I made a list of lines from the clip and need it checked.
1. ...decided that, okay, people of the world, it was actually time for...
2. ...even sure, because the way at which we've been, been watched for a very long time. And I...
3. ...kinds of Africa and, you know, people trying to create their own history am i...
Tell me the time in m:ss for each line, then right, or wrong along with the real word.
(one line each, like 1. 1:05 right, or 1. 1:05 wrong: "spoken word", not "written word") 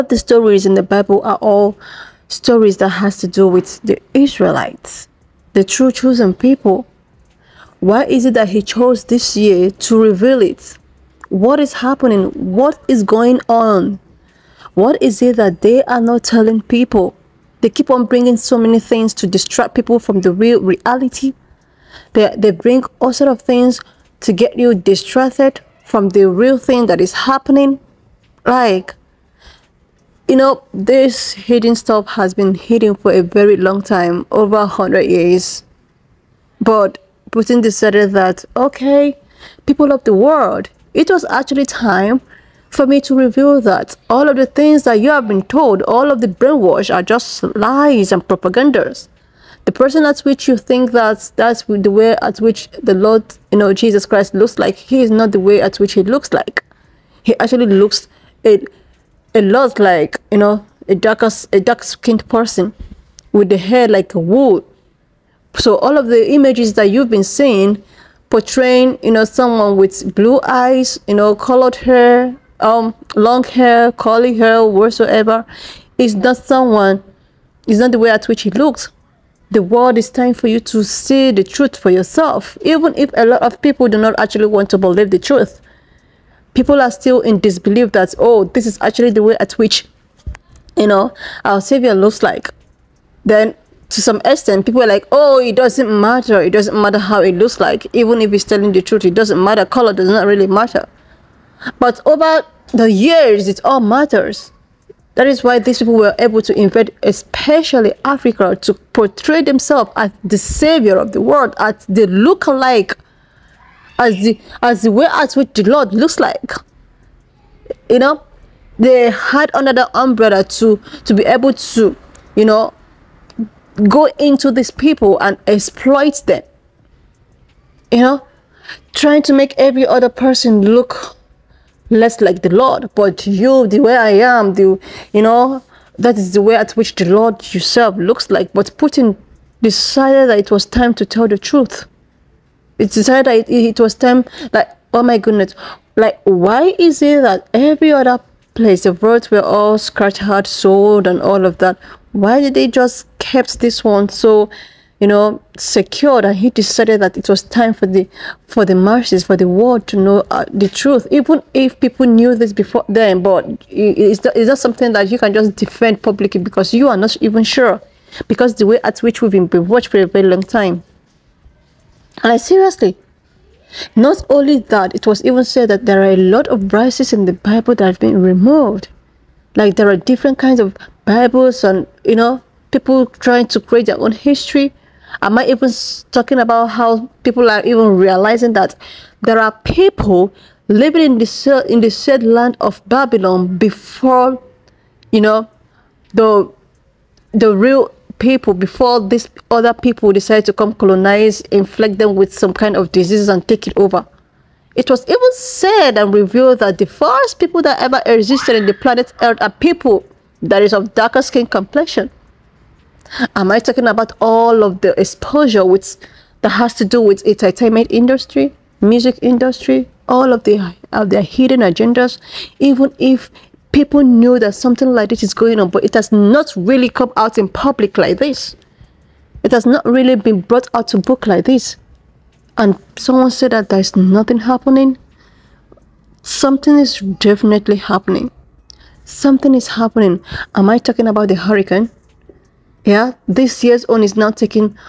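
1. 0:37 right
2. 2:47 right
3. 3:00 wrong: "Bibles", not "Africa".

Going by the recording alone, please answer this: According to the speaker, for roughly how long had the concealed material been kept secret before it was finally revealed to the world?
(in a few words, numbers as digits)
over 100 years.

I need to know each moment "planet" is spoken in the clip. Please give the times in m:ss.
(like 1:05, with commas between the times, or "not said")
3:28.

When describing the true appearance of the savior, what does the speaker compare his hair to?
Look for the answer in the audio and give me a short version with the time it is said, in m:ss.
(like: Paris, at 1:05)
like wool, at 1:03.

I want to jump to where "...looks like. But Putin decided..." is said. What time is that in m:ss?
2:17.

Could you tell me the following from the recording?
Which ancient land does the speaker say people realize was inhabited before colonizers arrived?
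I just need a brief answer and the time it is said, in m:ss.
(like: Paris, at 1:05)
Babylon, at 3:12.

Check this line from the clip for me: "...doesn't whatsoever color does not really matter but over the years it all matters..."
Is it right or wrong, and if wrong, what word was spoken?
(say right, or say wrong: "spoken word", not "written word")
wrong: "matter", not "whatsoever".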